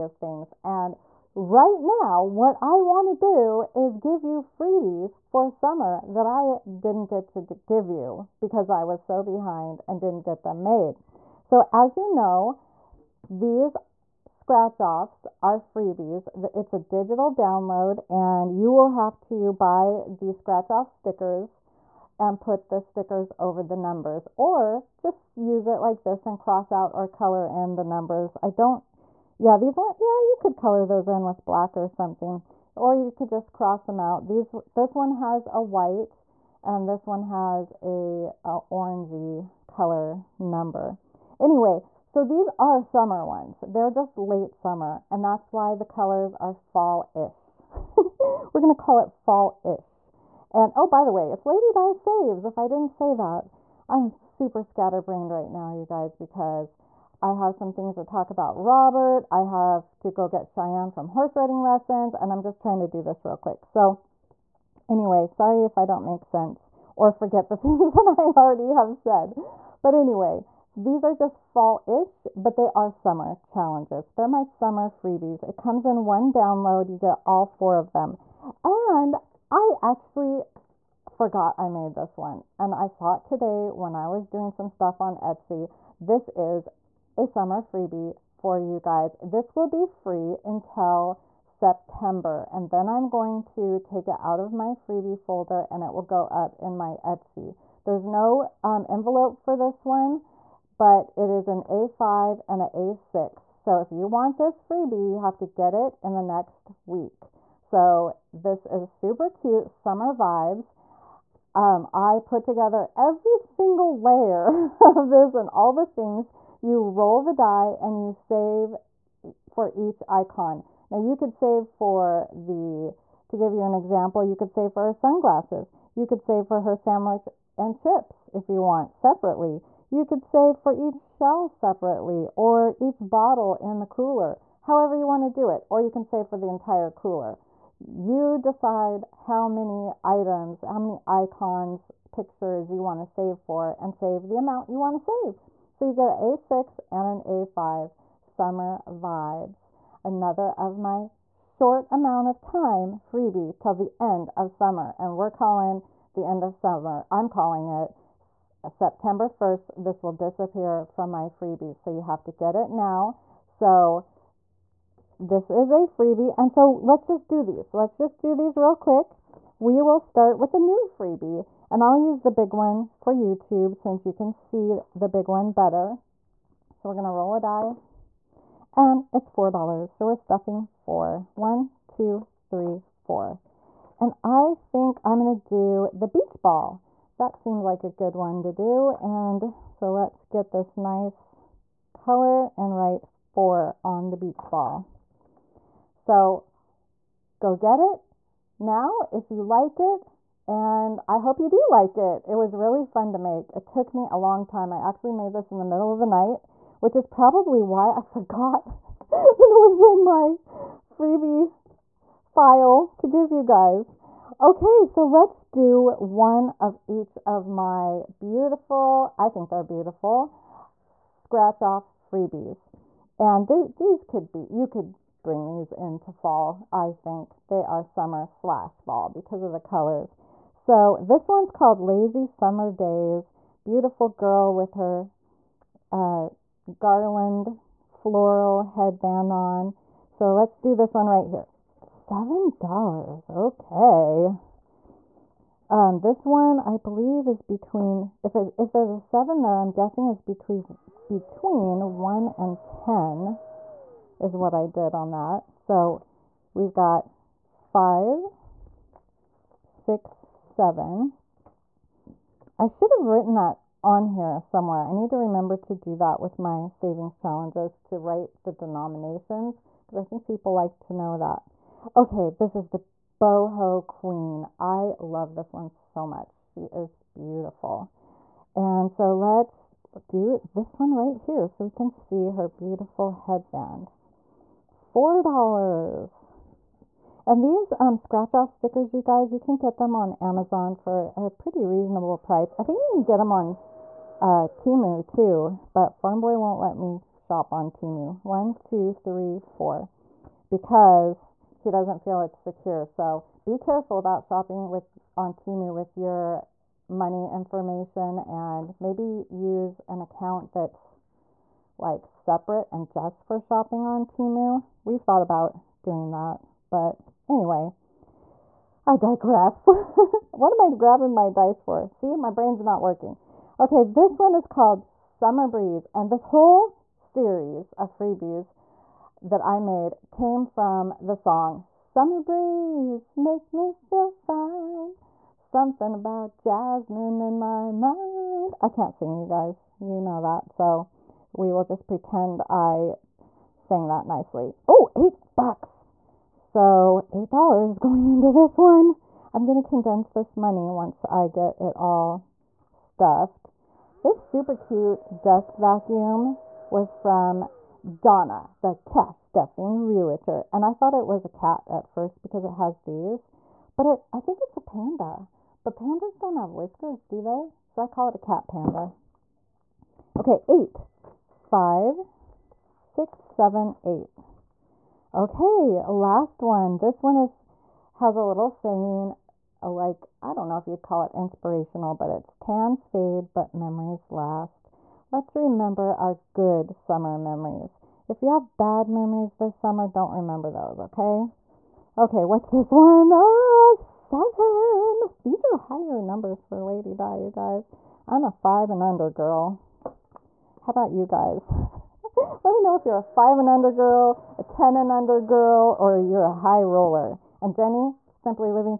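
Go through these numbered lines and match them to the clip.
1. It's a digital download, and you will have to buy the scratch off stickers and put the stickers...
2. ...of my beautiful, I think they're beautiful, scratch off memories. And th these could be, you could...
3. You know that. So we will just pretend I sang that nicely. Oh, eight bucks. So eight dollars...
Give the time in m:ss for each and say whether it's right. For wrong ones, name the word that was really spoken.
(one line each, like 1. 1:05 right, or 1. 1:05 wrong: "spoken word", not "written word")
1. 0:16 right
2. 3:37 wrong: "freebies", not "memories"
3. 5:39 right.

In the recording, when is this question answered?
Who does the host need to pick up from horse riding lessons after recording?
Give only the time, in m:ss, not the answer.
1:00.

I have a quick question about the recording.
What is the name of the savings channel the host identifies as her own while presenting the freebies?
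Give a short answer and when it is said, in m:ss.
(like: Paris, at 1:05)
Lady Di Saves, at 0:51.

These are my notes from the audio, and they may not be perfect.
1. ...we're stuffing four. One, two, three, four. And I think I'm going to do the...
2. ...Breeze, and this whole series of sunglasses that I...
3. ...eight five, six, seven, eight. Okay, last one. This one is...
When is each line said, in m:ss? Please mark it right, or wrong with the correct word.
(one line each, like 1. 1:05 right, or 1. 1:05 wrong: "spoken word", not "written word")
1. 3:00 right
2. 5:25 wrong: "freebies", not "sunglasses"
3. 6:10 right.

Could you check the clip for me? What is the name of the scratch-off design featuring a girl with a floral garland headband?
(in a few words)
Lazy Summer Days.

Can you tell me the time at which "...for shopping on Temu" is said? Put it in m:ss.
5:13.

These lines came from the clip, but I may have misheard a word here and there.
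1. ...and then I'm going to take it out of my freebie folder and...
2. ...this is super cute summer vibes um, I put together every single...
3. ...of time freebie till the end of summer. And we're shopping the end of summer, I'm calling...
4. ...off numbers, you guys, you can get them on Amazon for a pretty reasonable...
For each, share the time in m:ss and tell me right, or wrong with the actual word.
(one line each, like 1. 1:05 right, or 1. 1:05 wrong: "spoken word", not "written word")
1. 1:32 right
2. 1:48 right
3. 2:32 wrong: "calling", not "shopping"
4. 4:48 wrong: "stickers", not "numbers".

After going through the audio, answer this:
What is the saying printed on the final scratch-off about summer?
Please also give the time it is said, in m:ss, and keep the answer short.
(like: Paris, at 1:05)
Tans fade, but memories last, at 6:22.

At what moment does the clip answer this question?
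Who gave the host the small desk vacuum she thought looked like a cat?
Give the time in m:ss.
5:58.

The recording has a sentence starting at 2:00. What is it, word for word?
Now you could save for the, to give you an example, you could save for her sunglasses.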